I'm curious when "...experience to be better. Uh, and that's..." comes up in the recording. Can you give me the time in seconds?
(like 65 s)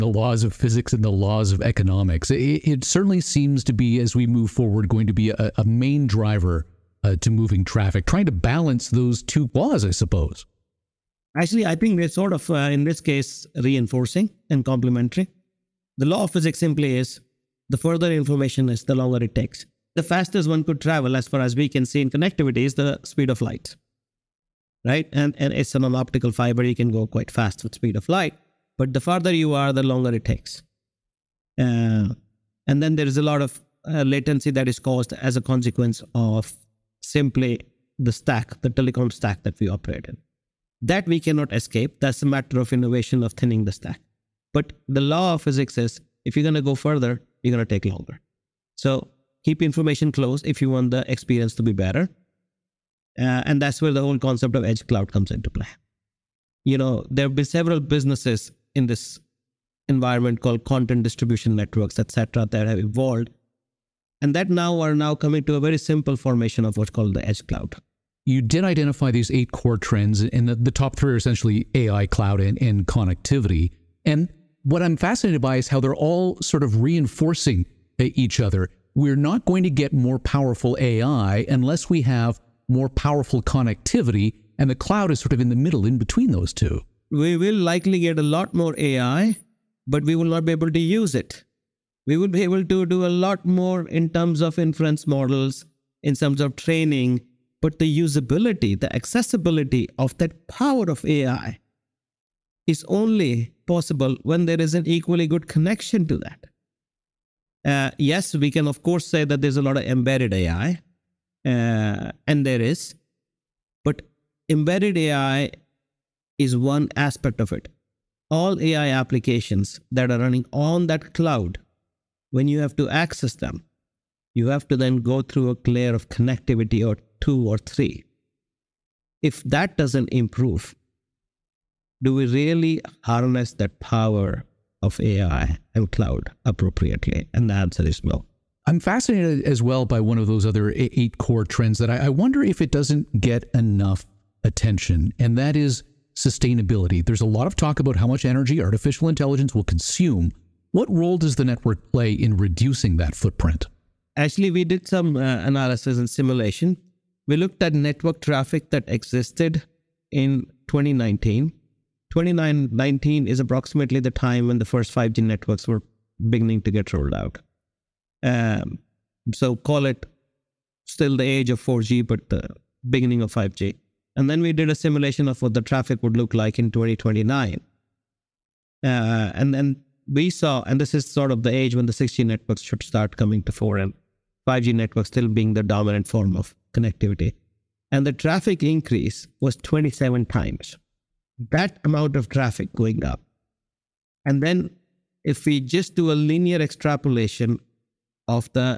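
51 s.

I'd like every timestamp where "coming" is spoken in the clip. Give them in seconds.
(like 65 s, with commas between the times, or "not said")
65 s, 183 s.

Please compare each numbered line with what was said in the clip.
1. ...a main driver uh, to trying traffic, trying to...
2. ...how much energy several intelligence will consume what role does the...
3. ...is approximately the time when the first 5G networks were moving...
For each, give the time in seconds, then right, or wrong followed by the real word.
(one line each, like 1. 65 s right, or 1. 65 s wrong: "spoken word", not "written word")
1. 5 s wrong: "moving", not "trying"
2. 147 s wrong: "artificial", not "several"
3. 163 s wrong: "beginning", not "moving".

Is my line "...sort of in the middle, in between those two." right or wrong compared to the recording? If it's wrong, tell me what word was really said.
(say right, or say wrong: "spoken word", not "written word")
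right.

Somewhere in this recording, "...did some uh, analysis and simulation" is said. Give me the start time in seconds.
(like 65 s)
154 s.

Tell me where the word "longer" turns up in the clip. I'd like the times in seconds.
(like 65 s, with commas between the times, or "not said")
18 s, 29 s, 47 s.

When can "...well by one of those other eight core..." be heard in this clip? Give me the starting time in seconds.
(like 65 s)
139 s.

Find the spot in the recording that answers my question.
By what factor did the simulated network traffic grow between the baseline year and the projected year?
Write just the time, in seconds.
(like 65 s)
189 s.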